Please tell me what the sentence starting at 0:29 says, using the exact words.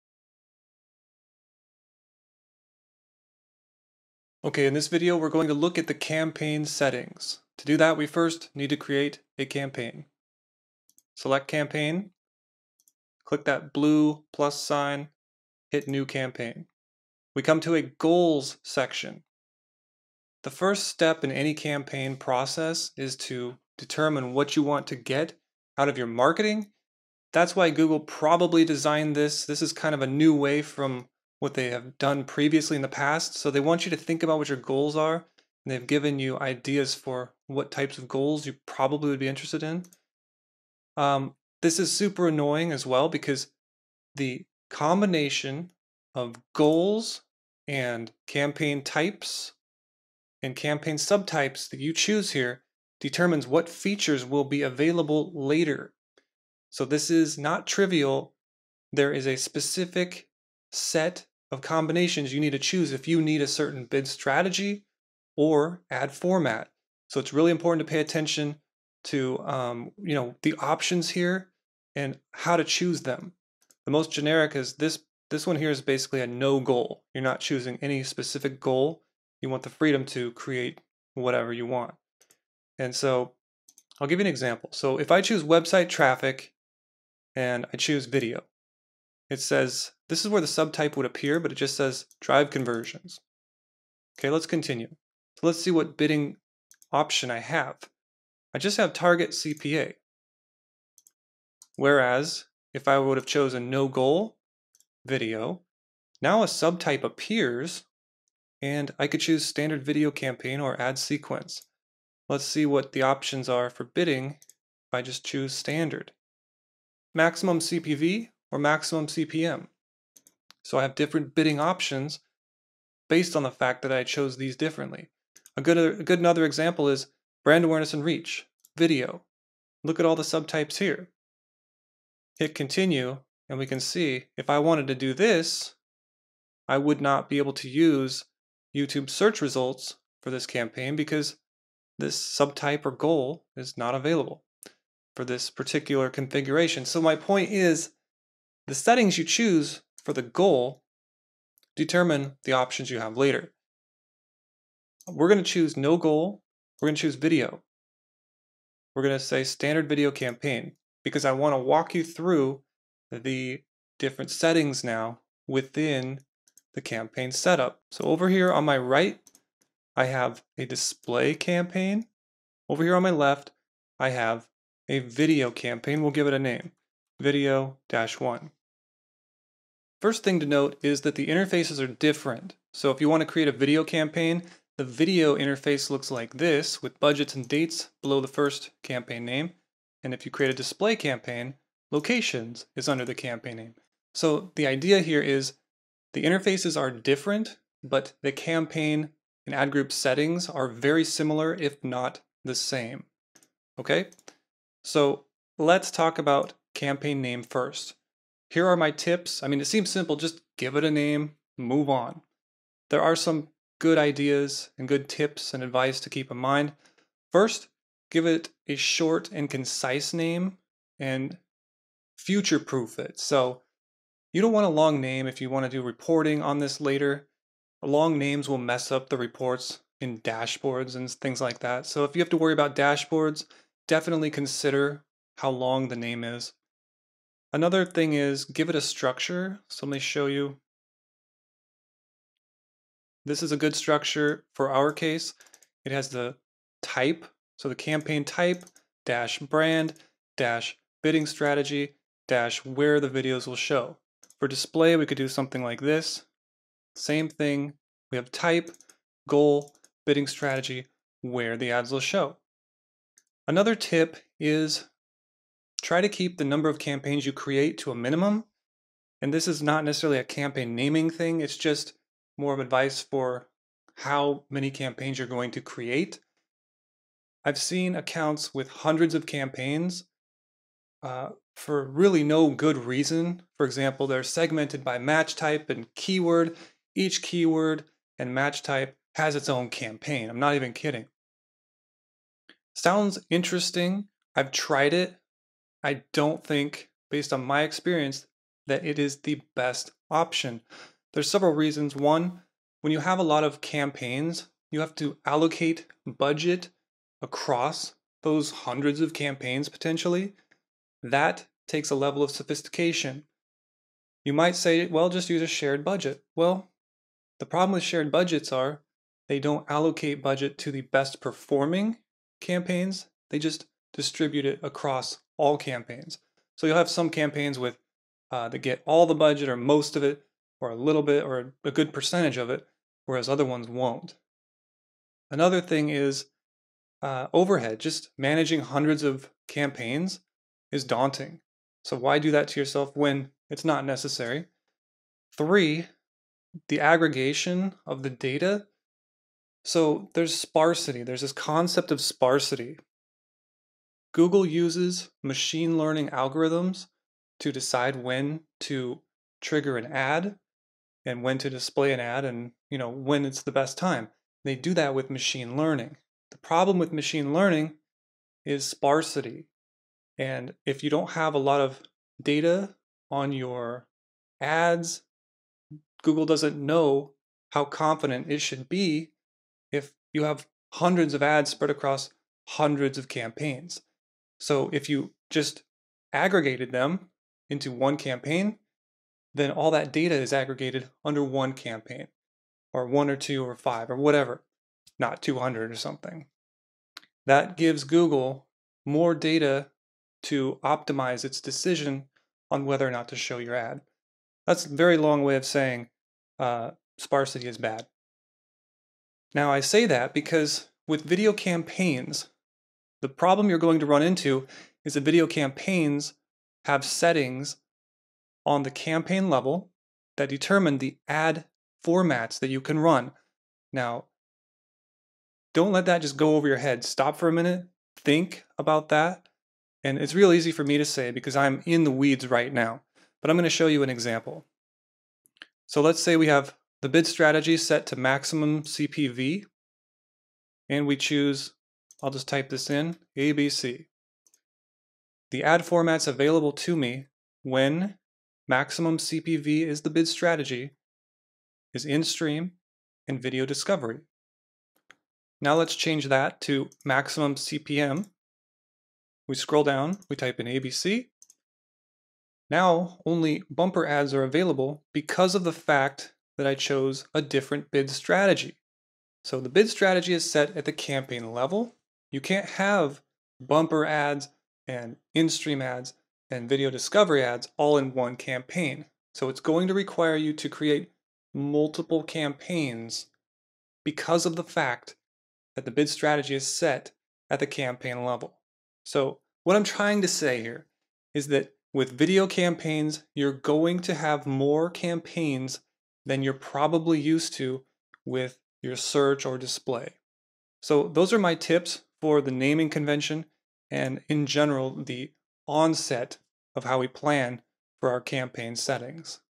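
This is kind of a new way from what they have done previously in the past.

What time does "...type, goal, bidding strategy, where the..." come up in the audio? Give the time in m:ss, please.
4:18.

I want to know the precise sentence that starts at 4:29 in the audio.
And this is not necessarily a campaign naming thing, it's just more of advice for how many campaigns you're going to create.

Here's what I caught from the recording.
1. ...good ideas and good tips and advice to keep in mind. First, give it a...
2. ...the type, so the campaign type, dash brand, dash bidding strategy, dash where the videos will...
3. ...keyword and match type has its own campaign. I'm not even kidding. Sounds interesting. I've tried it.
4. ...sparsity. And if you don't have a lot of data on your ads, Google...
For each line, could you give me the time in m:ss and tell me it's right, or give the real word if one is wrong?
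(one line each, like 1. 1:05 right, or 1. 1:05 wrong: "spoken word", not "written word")
1. 3:33 right
2. 4:06 right
3. 4:47 right
4. 6:08 right.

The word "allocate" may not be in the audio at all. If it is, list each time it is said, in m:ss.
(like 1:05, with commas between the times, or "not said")
5:05, 5:19.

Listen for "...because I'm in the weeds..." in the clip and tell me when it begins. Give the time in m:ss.
7:11.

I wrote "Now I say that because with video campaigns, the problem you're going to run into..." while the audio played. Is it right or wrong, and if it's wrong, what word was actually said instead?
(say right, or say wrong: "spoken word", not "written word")
right.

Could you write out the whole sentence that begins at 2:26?
So my point is the settings you choose for the goal, determine the options you have later.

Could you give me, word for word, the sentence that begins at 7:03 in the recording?
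Now, don't let that just go over your head.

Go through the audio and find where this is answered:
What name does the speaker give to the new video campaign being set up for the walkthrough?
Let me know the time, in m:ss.
2:57.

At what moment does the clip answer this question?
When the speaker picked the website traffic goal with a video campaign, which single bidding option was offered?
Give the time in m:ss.
1:38.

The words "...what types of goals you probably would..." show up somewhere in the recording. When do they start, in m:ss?
0:37.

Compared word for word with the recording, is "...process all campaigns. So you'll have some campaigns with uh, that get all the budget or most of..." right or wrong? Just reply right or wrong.
wrong.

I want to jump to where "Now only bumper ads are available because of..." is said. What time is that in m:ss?
7:42.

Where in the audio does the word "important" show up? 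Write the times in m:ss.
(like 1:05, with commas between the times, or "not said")
1:07.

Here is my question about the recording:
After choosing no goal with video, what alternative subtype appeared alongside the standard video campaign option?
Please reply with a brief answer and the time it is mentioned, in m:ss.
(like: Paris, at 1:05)
Ad sequence, at 1:50.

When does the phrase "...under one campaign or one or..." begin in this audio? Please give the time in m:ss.
6:31.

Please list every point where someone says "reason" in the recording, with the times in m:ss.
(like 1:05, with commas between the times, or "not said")
4:42, 5:01.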